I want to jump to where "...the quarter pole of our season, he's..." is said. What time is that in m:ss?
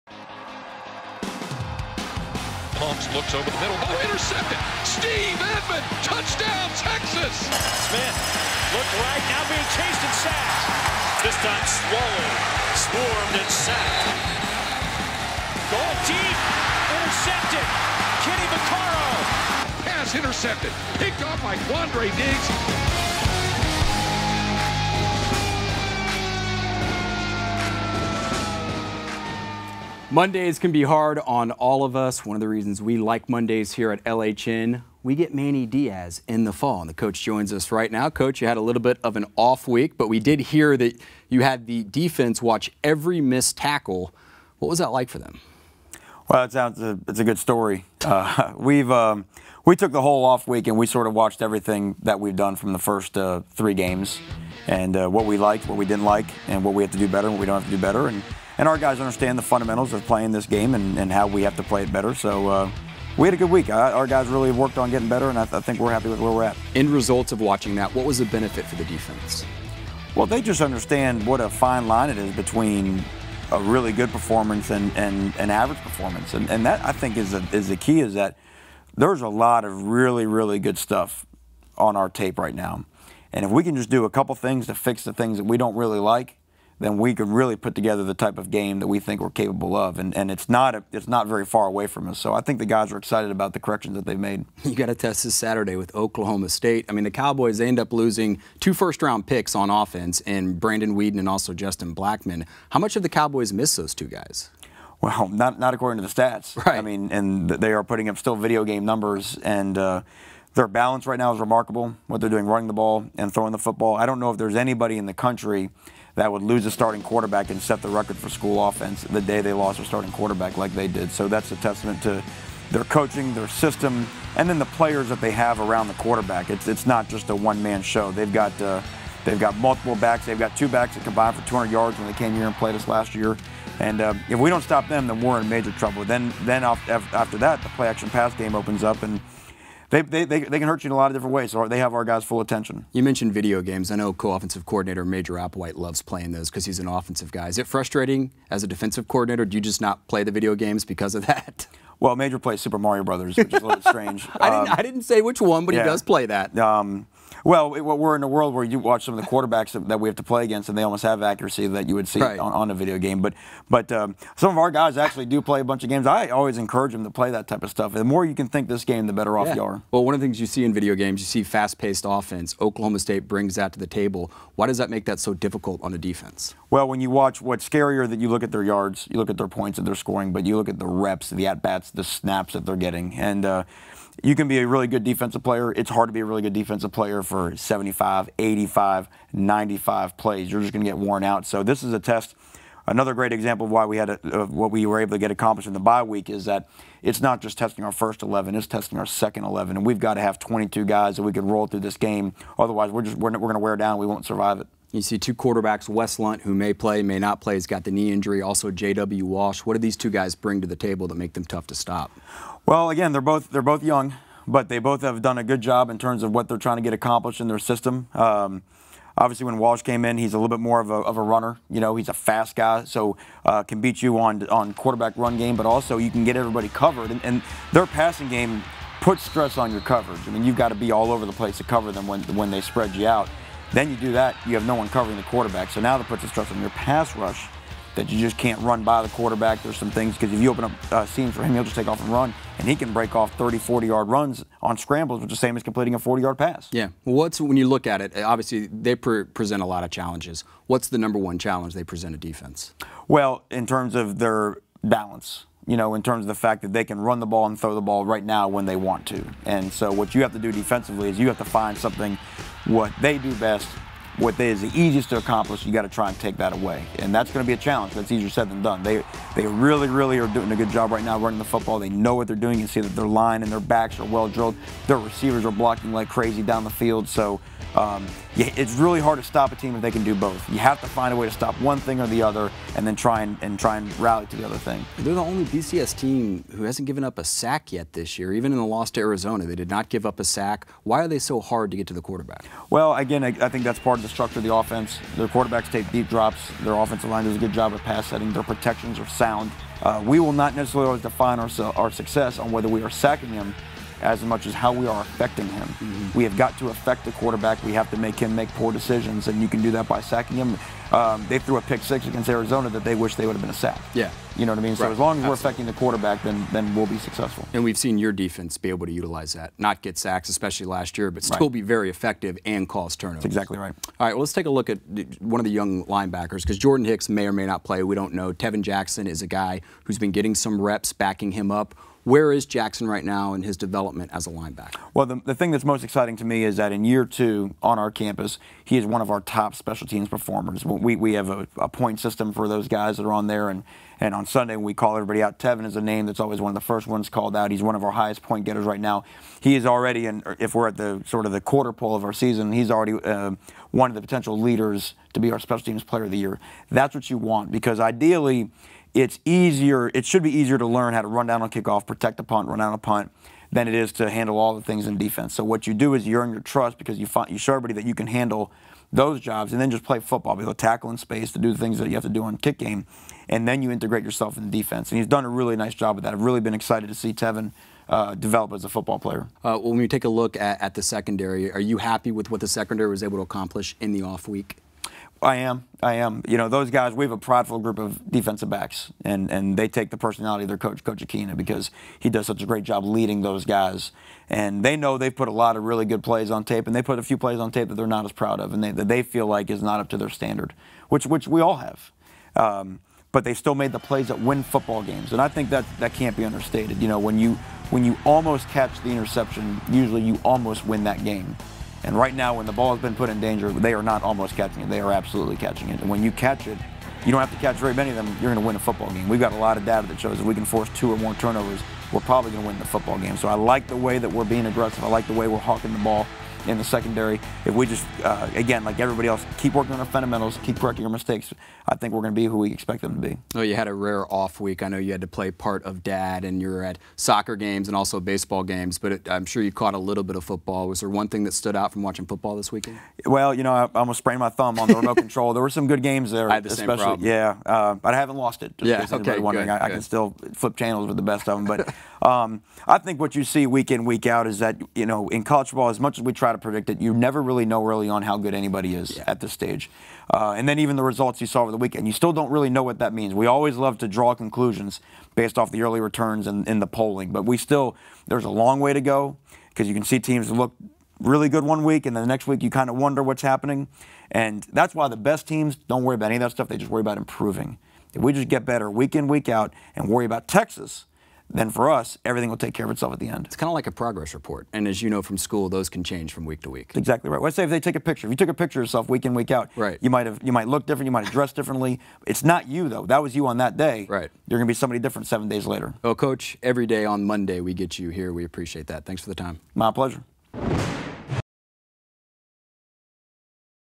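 5:51.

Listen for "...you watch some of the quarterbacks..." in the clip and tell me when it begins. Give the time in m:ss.
2:38.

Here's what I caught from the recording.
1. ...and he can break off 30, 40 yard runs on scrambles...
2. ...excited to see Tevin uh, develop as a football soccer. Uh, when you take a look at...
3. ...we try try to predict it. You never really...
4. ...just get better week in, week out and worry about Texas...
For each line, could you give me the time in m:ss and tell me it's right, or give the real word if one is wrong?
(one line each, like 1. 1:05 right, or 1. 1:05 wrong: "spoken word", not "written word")
1. 4:02 right
2. 6:16 wrong: "player", not "soccer"
3. 7:36 right
4. 7:58 right.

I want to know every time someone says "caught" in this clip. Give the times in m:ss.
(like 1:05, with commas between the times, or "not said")
7:19.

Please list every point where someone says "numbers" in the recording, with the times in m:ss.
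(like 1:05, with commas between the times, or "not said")
1:48, 4:10.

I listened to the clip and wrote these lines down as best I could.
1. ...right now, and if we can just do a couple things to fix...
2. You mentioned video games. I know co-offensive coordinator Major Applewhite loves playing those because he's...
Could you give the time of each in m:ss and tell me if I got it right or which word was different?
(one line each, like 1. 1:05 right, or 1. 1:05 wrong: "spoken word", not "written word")
1. 1:22 right
2. 2:22 right.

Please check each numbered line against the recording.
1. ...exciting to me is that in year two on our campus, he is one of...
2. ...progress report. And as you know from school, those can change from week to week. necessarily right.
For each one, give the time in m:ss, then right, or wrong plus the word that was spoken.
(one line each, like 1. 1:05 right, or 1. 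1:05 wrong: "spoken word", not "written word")
1. 5:35 right
2. 8:03 wrong: "exactly", not "necessarily".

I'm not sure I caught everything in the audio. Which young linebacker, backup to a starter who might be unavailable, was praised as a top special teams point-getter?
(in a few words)
Tevin Jackson.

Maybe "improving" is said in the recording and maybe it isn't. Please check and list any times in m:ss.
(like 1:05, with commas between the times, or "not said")
7:56.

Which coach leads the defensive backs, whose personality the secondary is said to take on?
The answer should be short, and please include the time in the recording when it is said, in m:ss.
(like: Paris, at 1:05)
Coach Akina, at 6:30.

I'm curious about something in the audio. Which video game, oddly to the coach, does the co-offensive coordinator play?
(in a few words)
Super Mario Brothers.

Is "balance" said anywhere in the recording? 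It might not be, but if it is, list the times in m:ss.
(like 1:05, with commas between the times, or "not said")
1:50, 4:14.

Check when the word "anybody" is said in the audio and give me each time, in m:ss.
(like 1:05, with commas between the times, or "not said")
1:54, 7:38.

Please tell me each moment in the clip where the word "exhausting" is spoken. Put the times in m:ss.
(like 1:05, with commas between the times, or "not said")
not said.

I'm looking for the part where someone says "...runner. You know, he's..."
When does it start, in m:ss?
3:41.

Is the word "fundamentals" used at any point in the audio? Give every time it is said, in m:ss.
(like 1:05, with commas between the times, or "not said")
0:59, 7:09.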